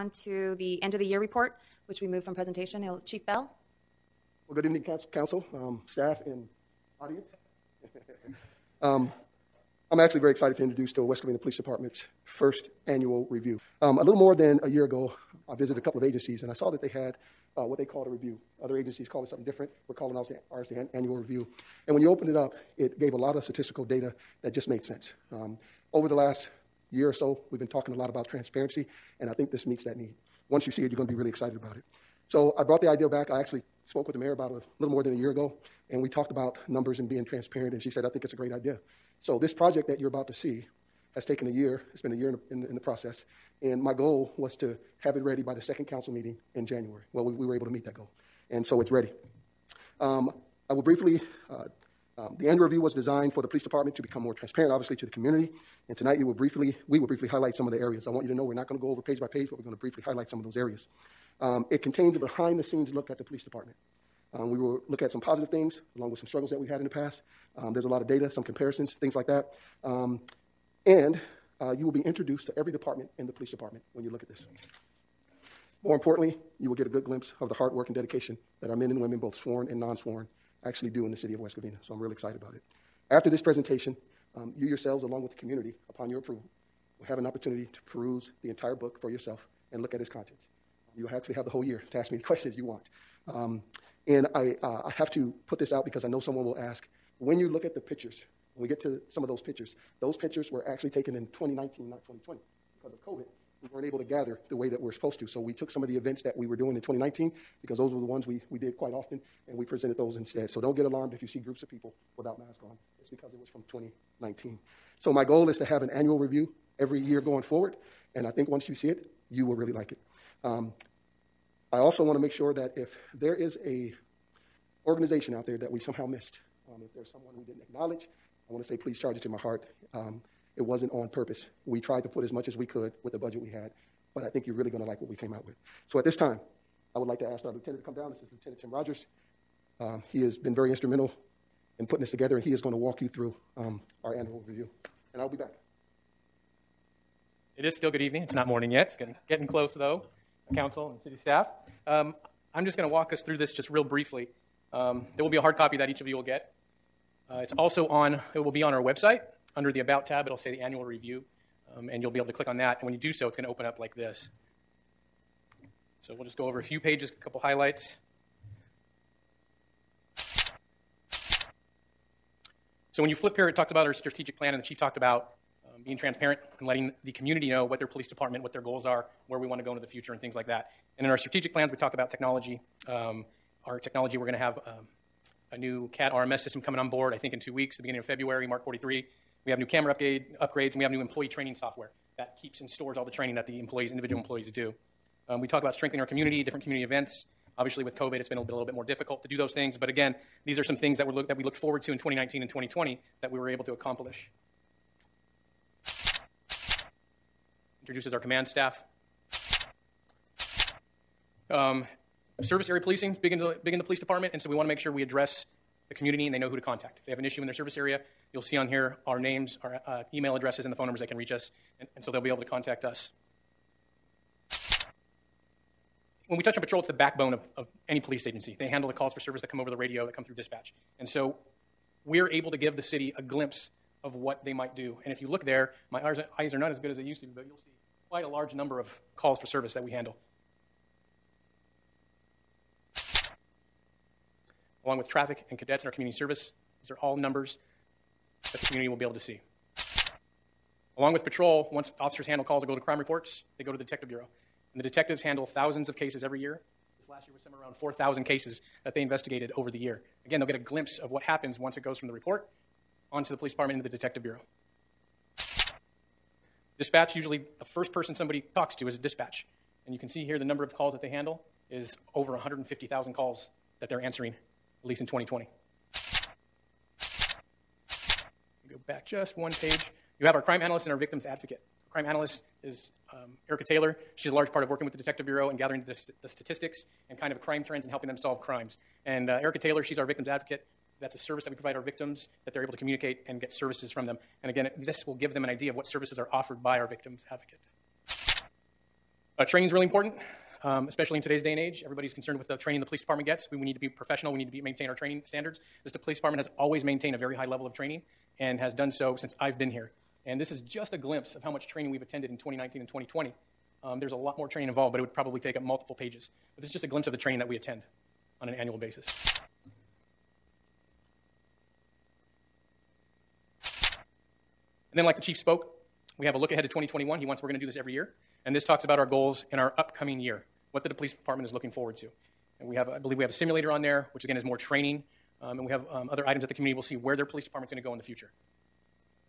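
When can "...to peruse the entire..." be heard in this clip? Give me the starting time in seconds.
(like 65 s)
87 s.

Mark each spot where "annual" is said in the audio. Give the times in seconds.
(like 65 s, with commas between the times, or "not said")
12 s, 20 s, 52 s, 115 s, 144 s, 160 s, 318 s.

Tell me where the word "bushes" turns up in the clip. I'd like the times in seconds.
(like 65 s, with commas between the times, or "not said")
not said.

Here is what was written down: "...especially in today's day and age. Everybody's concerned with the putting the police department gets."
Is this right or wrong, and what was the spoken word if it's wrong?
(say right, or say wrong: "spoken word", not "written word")
wrong: "training", not "putting".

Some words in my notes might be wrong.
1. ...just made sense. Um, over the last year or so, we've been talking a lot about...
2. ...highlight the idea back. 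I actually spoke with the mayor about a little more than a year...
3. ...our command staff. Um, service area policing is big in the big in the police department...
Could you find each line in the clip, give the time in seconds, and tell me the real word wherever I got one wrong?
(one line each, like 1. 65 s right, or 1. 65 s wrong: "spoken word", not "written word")
1. 24 s right
2. 32 s wrong: "brought", not "highlight"
3. 208 s right.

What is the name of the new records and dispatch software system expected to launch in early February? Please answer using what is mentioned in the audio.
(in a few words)
Mark 43.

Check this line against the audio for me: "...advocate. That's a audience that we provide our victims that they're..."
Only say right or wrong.
wrong.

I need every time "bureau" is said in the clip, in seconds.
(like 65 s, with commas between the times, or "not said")
254 s, 264 s, 285 s.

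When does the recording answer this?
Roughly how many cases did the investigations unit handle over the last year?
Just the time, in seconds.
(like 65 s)
257 s.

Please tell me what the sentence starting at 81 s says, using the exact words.
So I'm really excited about it.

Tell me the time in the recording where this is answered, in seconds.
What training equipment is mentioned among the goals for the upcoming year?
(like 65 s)
333 s.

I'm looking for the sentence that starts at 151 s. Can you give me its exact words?
Um, I'm just going to walk us through this just real briefly.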